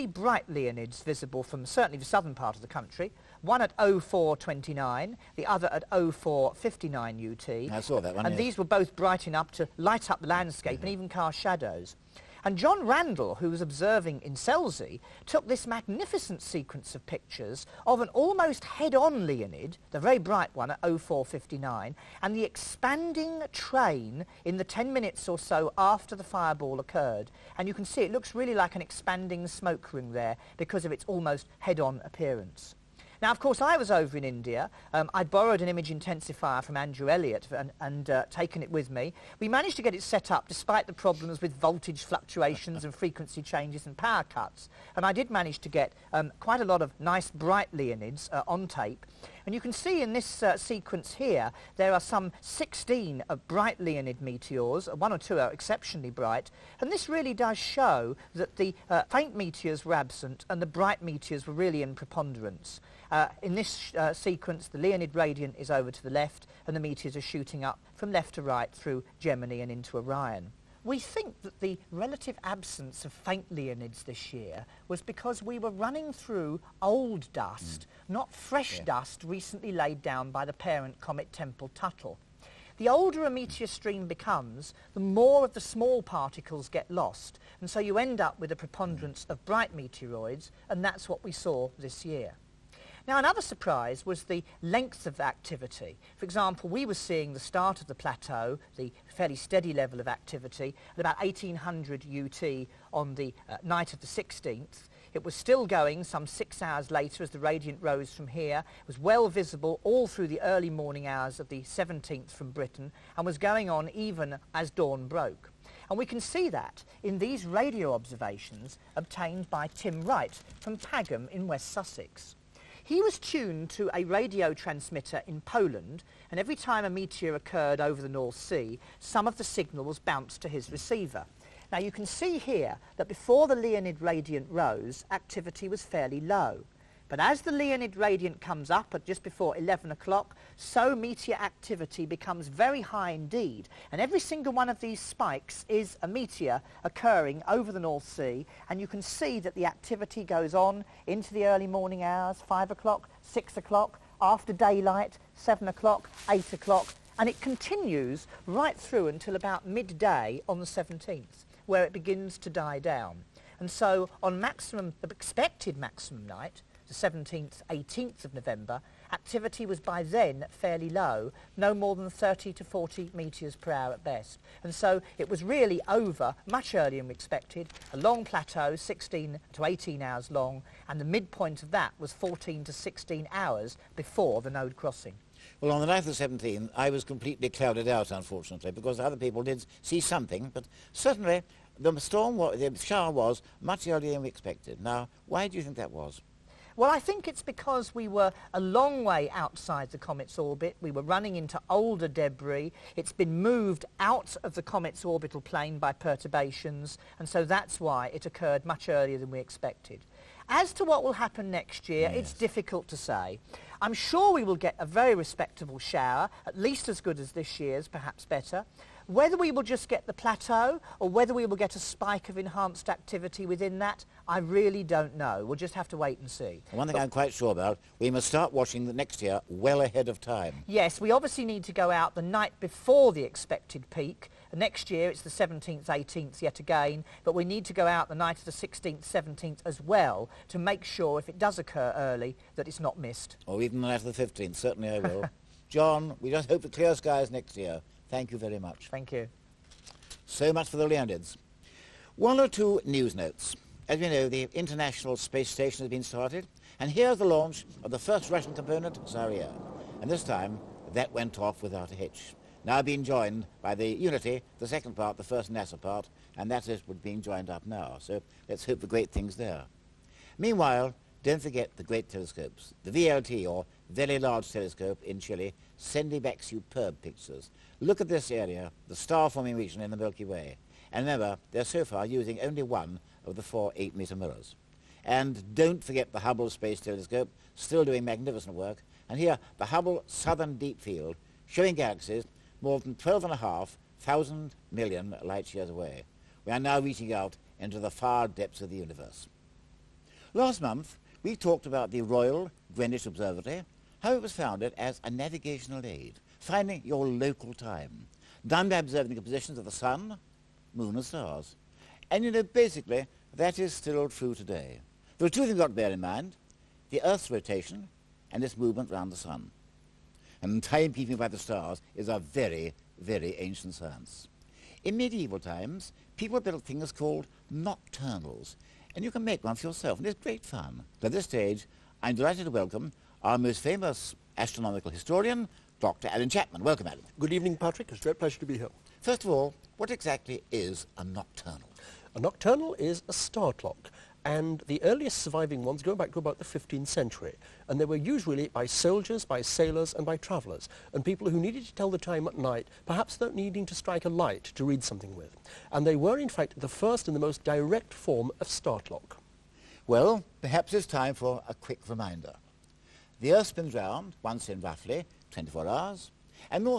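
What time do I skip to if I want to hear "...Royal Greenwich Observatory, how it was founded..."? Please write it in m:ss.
5:02.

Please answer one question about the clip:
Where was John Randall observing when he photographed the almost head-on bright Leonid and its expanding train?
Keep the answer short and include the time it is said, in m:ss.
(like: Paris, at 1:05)
Selsey, at 0:14.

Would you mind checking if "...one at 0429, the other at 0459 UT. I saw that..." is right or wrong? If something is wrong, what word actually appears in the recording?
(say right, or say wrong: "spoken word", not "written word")
right.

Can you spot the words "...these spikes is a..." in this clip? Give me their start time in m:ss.
2:24.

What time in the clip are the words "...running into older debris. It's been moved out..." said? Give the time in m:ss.
3:21.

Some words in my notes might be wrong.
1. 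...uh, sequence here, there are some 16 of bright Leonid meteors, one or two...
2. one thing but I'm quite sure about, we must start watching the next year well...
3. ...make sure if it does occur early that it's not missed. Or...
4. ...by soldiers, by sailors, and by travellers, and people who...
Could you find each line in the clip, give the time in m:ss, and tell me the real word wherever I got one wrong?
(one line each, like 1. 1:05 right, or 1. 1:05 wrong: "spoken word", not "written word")
1. 0:50 right
2. 3:46 right
3. 4:00 right
4. 5:48 right.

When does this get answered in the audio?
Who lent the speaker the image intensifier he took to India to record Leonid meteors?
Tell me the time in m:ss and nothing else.
0:36.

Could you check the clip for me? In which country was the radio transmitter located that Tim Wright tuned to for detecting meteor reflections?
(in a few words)
Poland.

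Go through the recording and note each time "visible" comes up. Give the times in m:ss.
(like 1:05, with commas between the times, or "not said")
0:01, 1:49.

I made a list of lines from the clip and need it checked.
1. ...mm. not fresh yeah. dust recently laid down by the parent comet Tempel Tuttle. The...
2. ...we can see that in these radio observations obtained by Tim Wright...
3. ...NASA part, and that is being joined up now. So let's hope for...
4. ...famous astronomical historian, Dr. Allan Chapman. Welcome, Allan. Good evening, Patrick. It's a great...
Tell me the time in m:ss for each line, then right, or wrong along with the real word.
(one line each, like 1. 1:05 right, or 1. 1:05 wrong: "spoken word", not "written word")
1. 1:17 right
2. 1:55 right
3. 4:25 right
4. 5:33 right.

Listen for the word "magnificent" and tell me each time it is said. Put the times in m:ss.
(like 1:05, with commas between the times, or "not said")
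0:15, 4:48.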